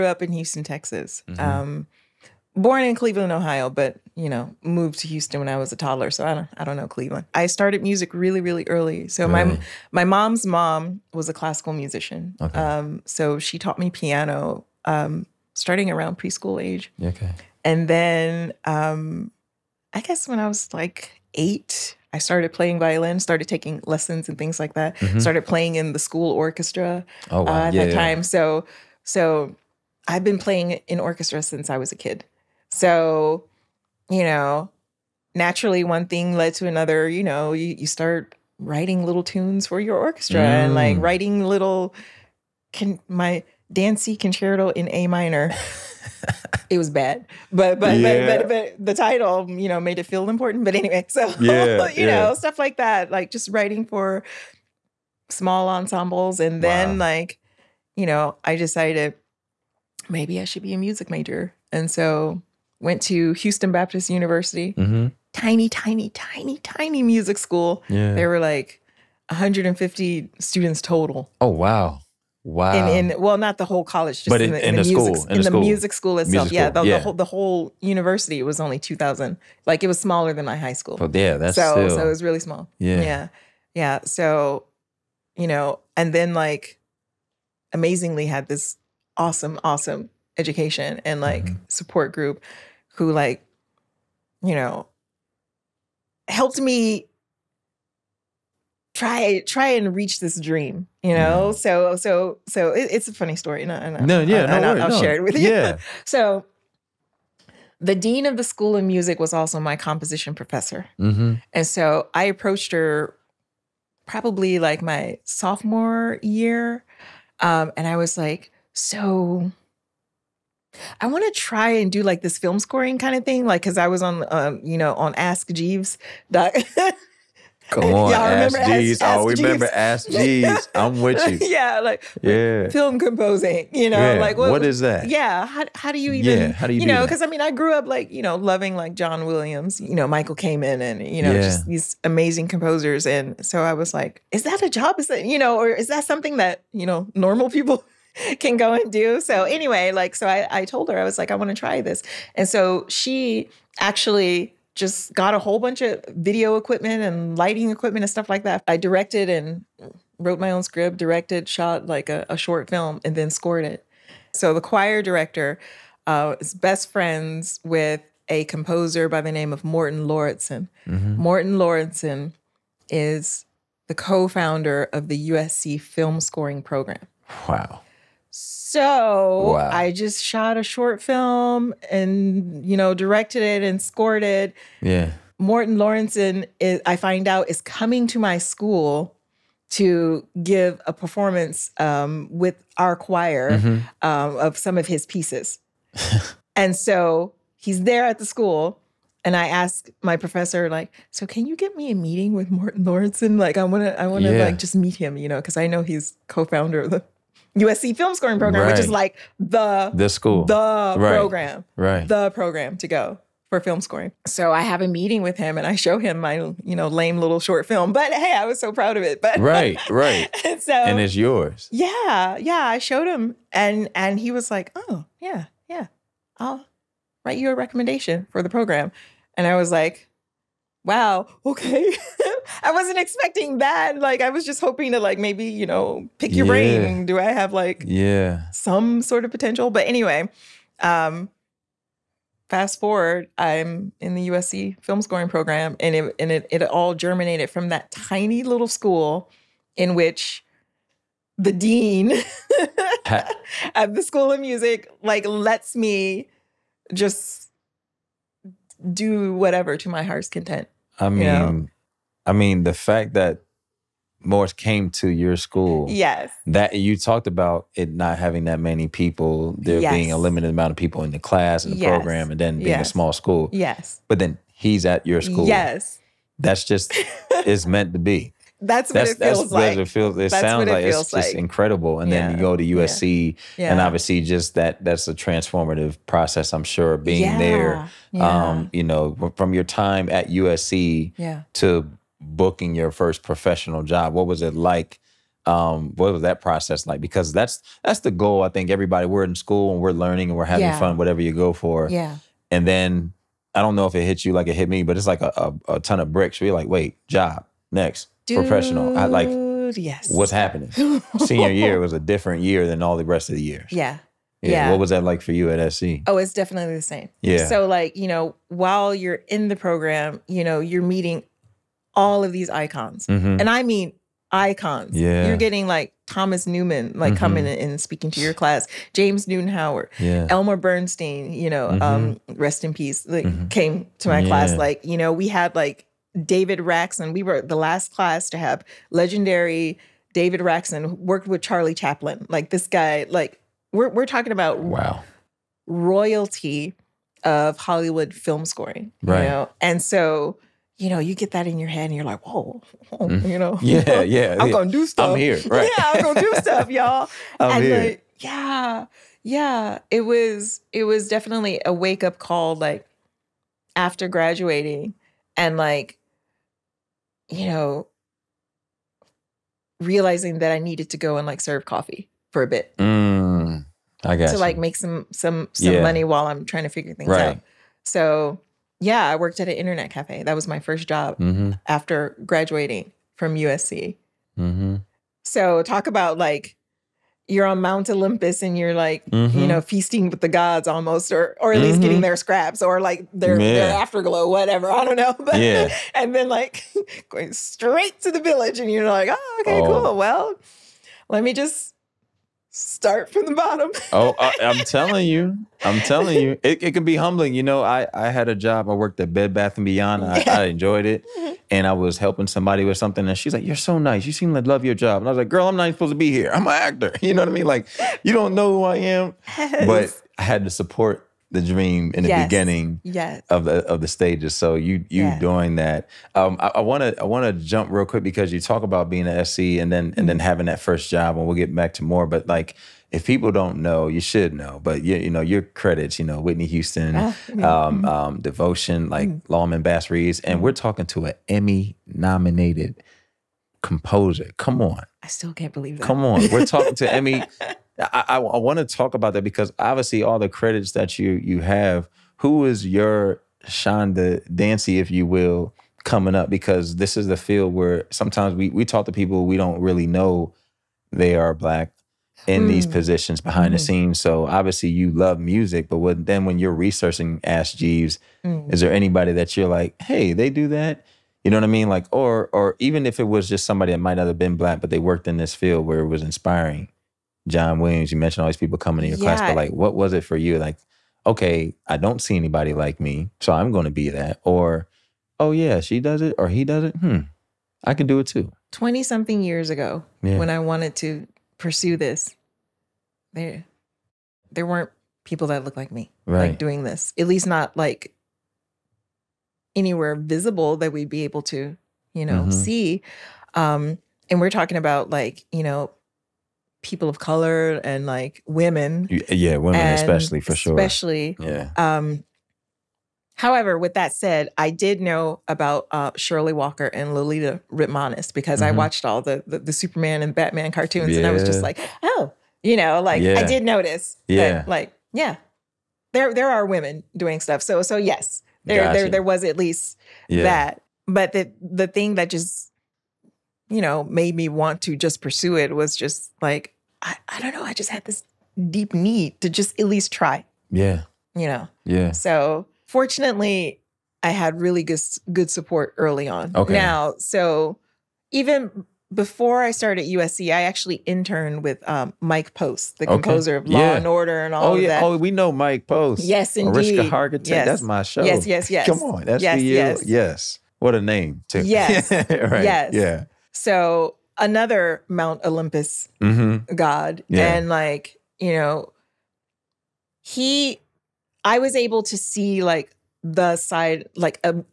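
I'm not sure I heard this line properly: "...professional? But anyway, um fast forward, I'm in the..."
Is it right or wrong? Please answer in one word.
wrong.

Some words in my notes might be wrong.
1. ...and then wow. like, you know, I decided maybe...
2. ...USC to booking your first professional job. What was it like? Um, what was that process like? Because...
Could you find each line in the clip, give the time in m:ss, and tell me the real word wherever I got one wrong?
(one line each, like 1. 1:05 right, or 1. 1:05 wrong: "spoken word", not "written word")
1. 0:56 right
2. 4:50 right.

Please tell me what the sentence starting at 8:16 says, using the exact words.
like doing this, at least not like anywhere visible that we'd be able to, you know, mm-hmm.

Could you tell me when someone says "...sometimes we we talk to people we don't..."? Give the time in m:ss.
7:37.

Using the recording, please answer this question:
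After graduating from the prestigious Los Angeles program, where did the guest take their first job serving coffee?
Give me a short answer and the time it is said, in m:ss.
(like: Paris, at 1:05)
internet cafe, at 6:19.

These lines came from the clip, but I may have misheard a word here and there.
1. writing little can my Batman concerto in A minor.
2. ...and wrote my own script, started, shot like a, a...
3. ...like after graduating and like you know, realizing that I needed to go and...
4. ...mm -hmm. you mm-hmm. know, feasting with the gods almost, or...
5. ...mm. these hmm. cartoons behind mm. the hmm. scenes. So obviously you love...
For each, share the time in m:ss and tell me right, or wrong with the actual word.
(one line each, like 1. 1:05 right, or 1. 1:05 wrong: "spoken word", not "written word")
1. 0:41 wrong: "Dancy", not "Batman"
2. 2:39 wrong: "directed", not "started"
3. 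6:02 right
4. 6:29 right
5. 7:42 wrong: "positions", not "cartoons".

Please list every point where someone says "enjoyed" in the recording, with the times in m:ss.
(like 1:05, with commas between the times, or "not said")
6:50.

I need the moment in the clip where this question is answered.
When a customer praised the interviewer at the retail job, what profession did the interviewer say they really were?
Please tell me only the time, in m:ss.
6:56.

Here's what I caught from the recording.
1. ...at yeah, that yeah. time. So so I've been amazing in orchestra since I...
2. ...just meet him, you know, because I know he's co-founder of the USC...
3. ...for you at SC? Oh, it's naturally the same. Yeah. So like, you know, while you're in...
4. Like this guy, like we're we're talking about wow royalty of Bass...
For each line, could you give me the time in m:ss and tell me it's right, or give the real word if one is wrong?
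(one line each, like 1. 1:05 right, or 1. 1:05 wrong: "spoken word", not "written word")
1. 0:27 wrong: "playing", not "amazing"
2. 3:24 right
3. 5:15 wrong: "definitely", not "naturally"
4. 5:42 wrong: "Hollywood", not "Bass".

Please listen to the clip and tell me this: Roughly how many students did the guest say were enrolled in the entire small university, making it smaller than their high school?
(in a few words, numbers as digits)
2000.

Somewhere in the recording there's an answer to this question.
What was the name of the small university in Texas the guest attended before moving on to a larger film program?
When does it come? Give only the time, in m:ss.
1:03.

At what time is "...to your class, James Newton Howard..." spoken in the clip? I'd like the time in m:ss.
5:28.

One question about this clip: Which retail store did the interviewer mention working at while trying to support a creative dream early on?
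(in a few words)
Bed Bath and Beyond.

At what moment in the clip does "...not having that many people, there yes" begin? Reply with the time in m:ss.
4:27.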